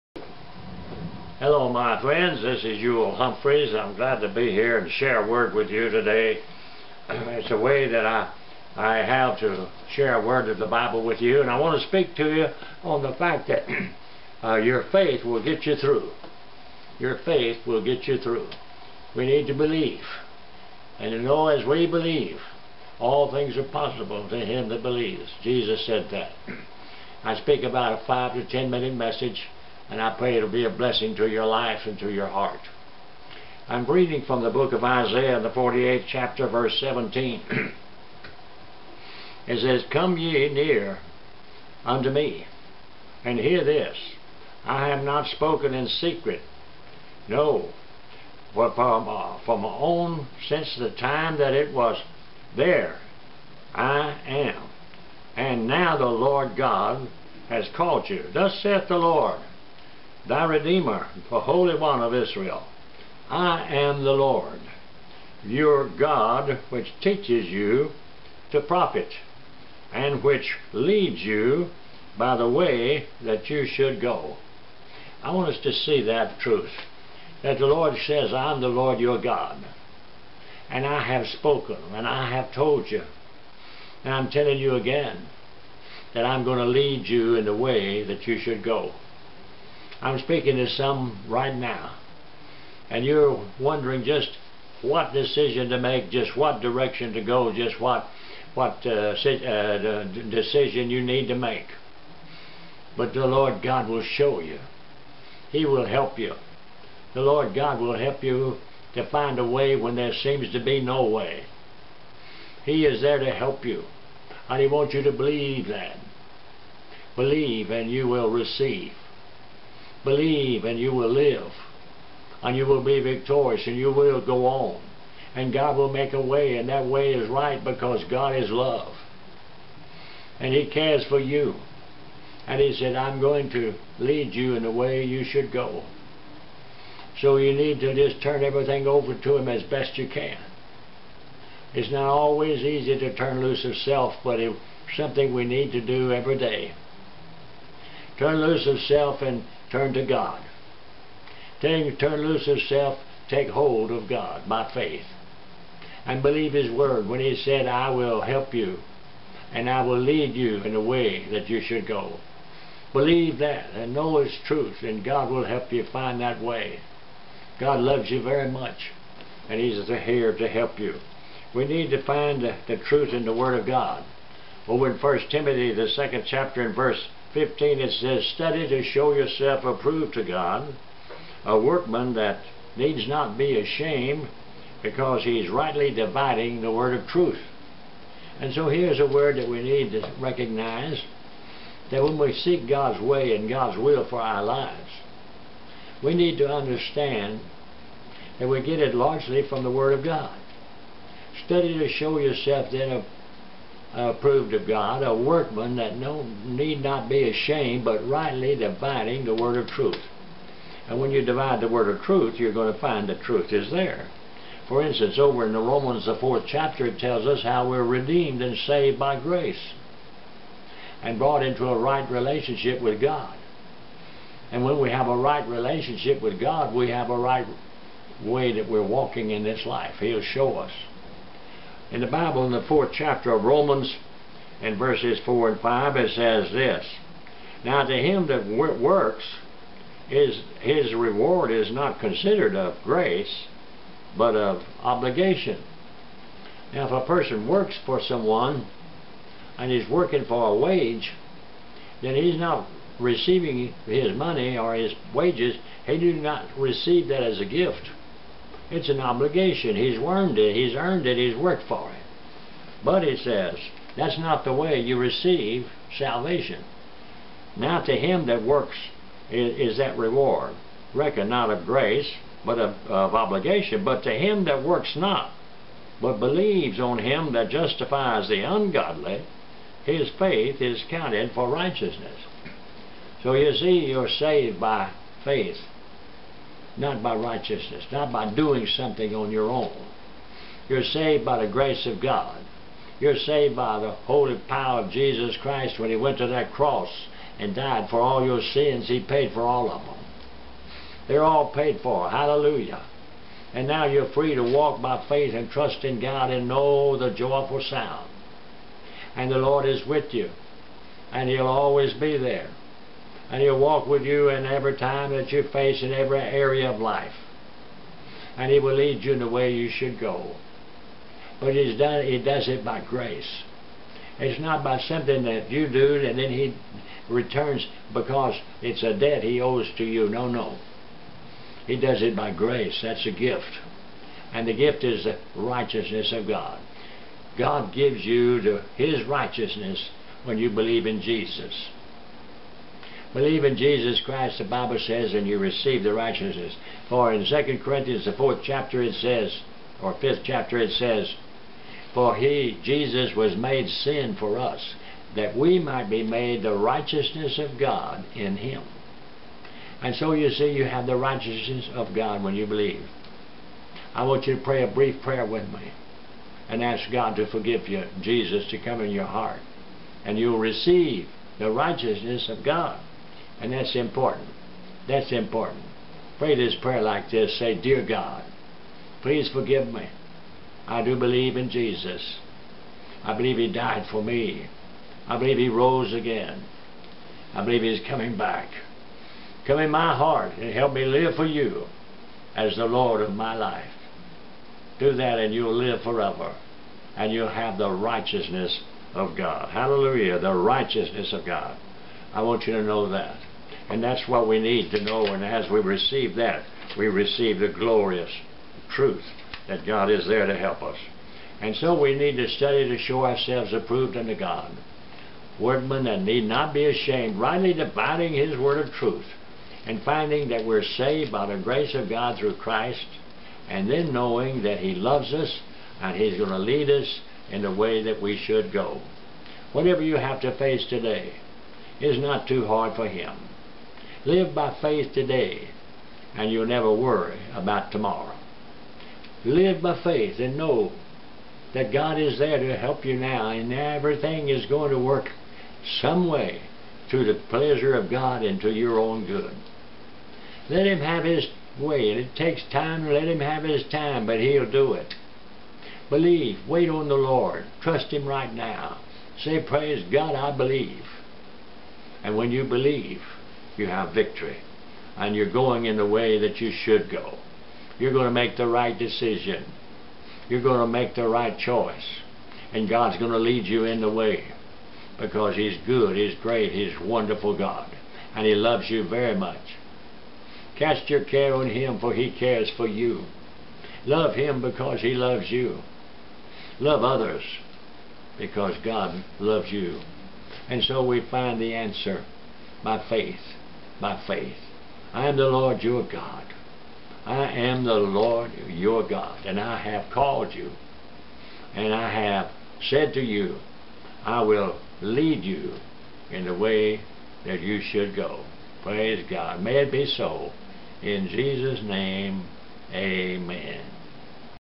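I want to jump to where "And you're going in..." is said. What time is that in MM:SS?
07:44.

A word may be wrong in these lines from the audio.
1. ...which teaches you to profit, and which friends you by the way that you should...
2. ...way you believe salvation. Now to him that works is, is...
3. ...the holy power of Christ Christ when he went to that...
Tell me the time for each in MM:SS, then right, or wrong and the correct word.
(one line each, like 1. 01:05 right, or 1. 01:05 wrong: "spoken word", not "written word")
1. 01:06 wrong: "leads", not "friends"
2. 04:24 wrong: "receive", not "believe"
3. 04:53 wrong: "Jesus", not "Christ".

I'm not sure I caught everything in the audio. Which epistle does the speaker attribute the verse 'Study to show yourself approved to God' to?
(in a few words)
1 Timothy.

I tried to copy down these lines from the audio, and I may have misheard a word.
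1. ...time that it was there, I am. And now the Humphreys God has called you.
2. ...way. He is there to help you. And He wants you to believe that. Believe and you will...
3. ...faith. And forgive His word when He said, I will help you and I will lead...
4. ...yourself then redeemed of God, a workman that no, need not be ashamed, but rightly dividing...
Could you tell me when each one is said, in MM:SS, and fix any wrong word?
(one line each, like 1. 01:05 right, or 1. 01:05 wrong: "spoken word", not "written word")
1. 00:50 wrong: "Lord", not "Humphreys"
2. 01:51 right
3. 02:34 wrong: "believe", not "forgive"
4. 03:22 wrong: "approved", not "redeemed".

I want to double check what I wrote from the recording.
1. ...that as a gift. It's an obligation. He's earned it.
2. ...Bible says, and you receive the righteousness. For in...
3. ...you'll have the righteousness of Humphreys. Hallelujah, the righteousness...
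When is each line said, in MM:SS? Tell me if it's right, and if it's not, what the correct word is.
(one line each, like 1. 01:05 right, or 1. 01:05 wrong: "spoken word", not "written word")
1. 04:17 right
2. 05:44 right
3. 06:37 wrong: "God", not "Humphreys".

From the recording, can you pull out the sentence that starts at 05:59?
And so you see, you have the righteousness of God when you believe.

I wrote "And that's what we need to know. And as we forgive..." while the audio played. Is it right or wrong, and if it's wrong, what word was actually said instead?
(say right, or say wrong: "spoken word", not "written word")
wrong: "receive", not "forgive".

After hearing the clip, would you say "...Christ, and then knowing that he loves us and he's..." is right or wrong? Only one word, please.
right.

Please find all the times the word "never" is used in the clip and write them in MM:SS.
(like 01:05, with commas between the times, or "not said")
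07:16.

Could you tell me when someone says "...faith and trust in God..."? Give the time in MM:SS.
05:05.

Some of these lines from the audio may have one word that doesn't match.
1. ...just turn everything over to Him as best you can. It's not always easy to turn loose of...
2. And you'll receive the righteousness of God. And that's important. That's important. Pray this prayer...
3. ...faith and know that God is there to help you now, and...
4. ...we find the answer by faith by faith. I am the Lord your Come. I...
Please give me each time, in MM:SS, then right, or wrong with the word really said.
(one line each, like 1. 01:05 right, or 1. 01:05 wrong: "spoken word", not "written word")
1. 02:17 right
2. 06:10 right
3. 07:19 right
4. 08:10 wrong: "God", not "Come".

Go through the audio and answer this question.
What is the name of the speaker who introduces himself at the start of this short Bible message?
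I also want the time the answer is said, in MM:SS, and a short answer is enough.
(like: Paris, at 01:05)
Ewell Humphreys, at 00:02.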